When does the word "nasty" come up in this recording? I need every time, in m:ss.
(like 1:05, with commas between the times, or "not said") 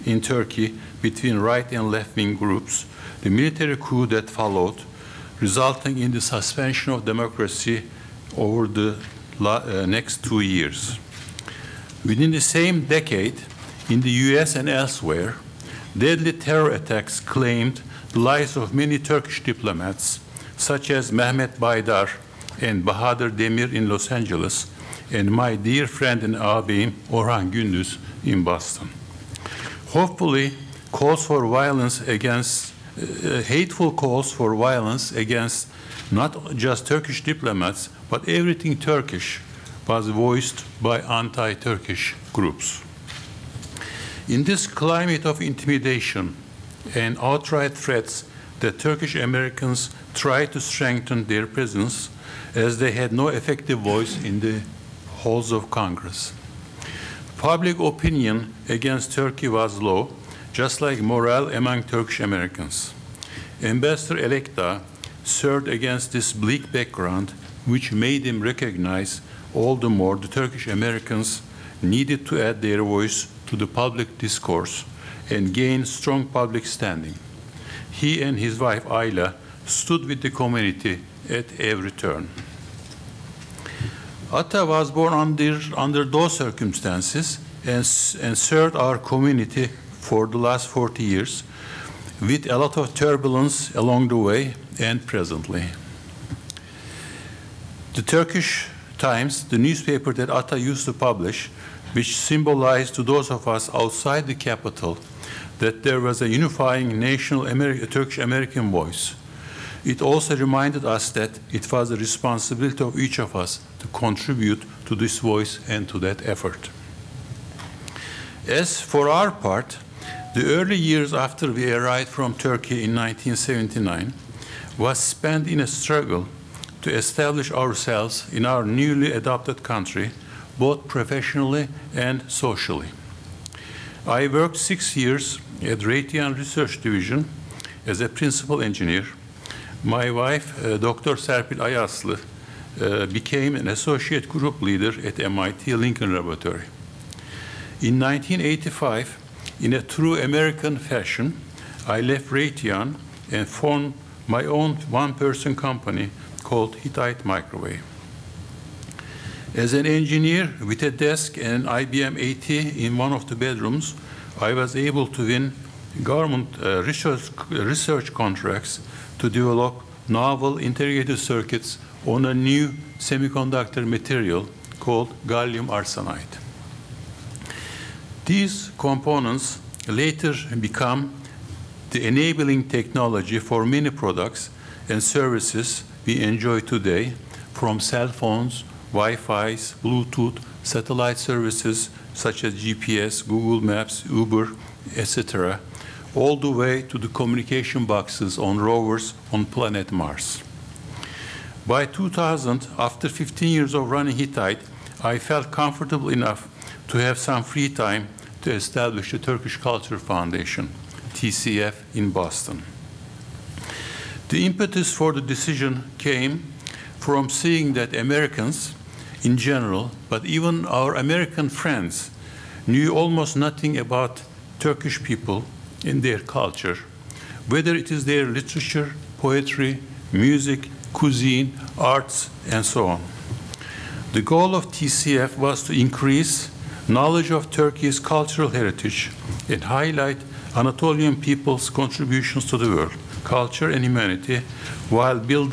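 not said.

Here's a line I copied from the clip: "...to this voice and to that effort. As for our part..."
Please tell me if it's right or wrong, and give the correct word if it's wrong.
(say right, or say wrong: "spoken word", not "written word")
right.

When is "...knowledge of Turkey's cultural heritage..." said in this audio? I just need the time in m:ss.
3:56.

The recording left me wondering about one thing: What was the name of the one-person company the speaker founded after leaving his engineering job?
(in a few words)
Hittite Microwave.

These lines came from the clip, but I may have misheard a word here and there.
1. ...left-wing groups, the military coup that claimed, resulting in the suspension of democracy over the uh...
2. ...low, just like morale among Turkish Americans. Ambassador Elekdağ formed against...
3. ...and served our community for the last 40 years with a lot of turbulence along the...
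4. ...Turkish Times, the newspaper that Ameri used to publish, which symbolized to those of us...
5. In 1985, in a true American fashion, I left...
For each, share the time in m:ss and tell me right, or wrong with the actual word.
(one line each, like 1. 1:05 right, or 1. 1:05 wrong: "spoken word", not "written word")
1. 0:01 wrong: "followed", not "claimed"
2. 0:59 wrong: "served", not "formed"
3. 1:28 right
4. 1:38 wrong: "ATA", not "Ameri"
5. 2:27 right.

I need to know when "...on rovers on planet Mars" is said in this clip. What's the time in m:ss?
3:18.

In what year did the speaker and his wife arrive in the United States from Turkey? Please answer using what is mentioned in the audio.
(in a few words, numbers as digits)
1979.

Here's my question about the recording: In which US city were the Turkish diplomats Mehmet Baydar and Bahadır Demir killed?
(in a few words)
Los Angeles.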